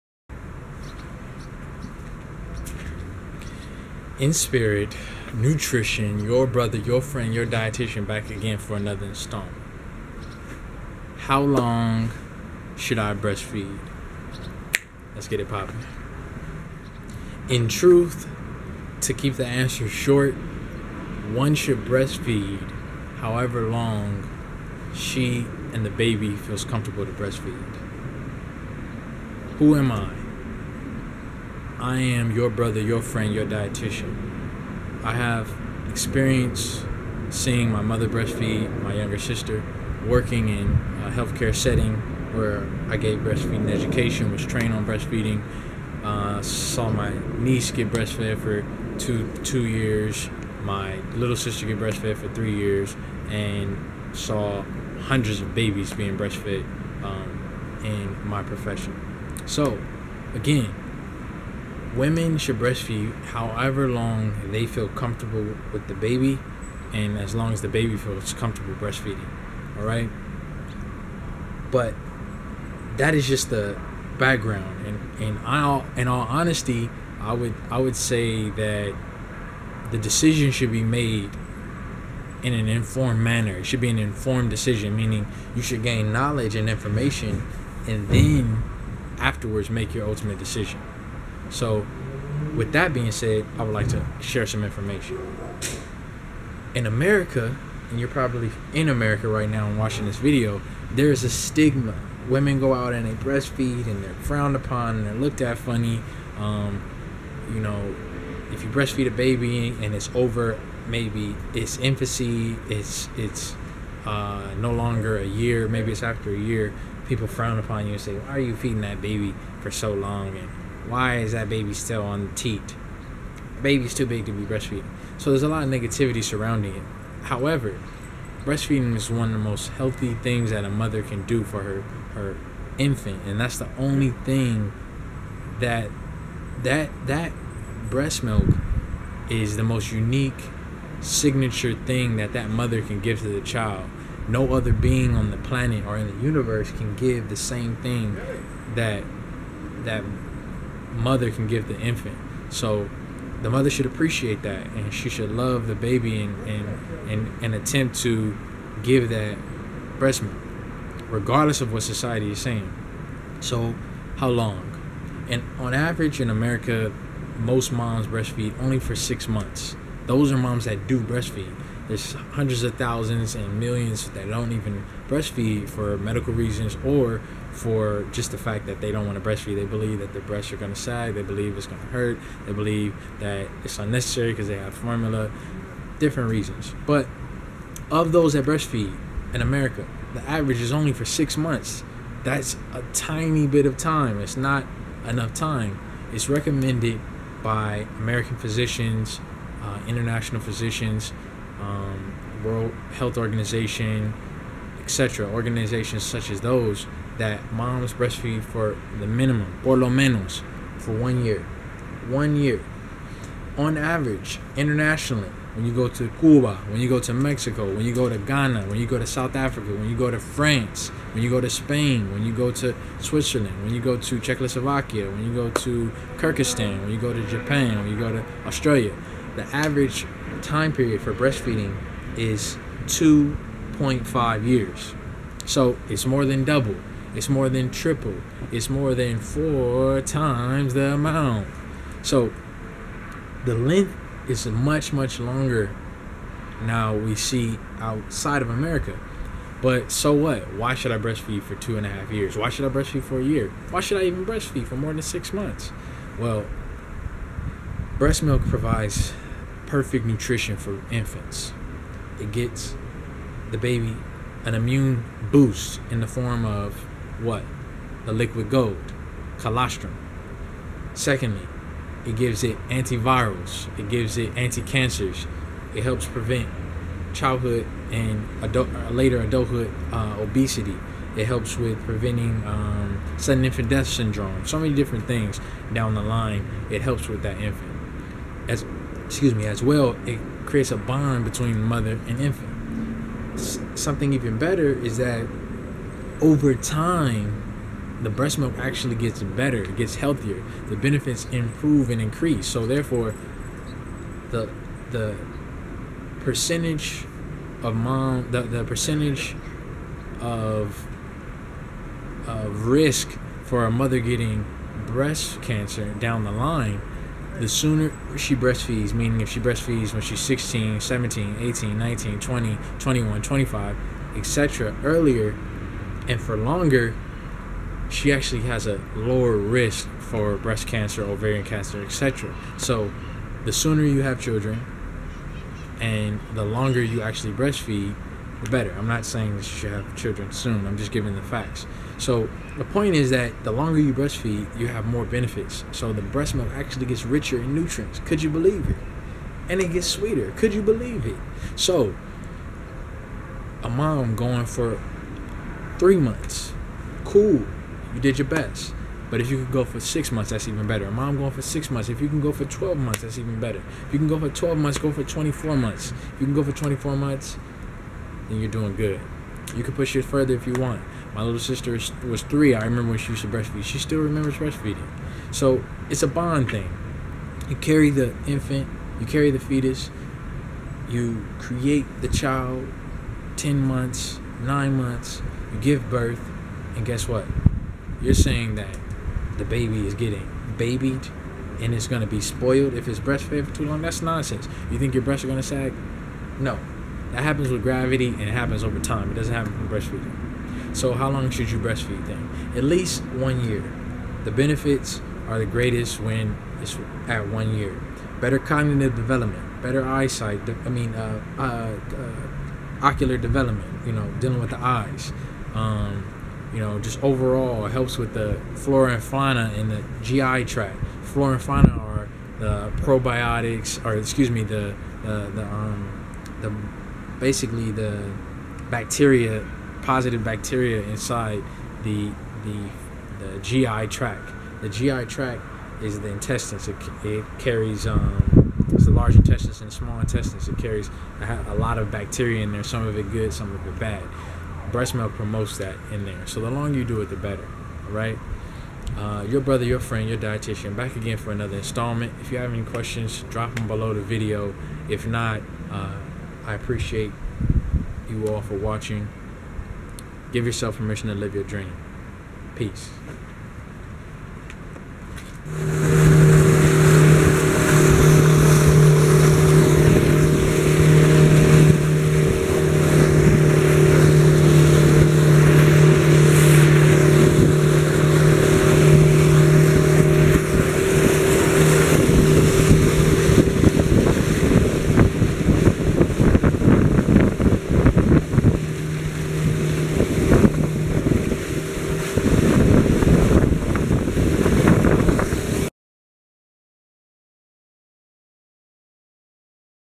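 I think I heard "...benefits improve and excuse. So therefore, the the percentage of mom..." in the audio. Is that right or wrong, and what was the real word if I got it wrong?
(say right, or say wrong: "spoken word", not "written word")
wrong: "increase", not "excuse".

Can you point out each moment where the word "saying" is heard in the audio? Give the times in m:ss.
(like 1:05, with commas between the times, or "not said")
2:42, 5:39, 6:28.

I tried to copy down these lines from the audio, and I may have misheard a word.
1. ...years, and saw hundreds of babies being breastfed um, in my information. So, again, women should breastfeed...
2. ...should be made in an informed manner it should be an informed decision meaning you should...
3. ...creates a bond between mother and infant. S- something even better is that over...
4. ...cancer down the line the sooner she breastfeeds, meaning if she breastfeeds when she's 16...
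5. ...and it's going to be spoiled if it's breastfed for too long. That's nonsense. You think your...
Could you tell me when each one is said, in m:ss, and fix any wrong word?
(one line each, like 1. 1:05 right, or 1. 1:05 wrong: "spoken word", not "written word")
1. 0:52 wrong: "profession", not "information"
2. 1:20 right
3. 4:50 right
4. 5:15 right
5. 6:31 right.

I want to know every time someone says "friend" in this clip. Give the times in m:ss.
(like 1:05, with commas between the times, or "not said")
0:07, 0:33, 7:29.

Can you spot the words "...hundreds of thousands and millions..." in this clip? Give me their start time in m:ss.
2:52.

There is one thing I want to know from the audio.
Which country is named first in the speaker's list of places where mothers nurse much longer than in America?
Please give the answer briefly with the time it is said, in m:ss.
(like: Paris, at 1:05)
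Cuba, at 3:36.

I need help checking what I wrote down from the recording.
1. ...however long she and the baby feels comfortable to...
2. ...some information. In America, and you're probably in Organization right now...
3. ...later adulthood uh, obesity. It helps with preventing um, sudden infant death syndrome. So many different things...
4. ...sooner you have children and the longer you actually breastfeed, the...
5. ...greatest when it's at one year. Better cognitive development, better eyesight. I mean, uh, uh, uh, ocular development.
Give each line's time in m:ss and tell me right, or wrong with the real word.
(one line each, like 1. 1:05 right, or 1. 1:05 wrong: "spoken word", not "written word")
1. 0:23 right
2. 1:34 wrong: "America", not "Organization"
3. 4:38 right
4. 5:33 right
5. 6:45 right.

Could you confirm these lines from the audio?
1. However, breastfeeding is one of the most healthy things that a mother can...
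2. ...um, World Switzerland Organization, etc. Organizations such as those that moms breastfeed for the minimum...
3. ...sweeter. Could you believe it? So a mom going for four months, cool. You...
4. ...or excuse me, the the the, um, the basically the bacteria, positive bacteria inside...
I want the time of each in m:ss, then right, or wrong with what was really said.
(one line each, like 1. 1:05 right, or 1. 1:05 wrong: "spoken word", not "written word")
1. 2:07 right
2. 3:21 wrong: "Health", not "Switzerland"
3. 5:49 wrong: "three", not "four"
4. 7:03 right.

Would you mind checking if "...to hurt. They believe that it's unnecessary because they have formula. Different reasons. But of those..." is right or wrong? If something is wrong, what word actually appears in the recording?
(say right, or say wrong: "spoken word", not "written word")
right.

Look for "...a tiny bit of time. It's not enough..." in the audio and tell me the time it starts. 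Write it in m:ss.
3:12.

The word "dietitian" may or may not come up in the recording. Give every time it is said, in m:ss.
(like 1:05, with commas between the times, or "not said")
0:07, 0:33, 7:30.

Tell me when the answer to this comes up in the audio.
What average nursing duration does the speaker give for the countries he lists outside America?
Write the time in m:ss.
3:52.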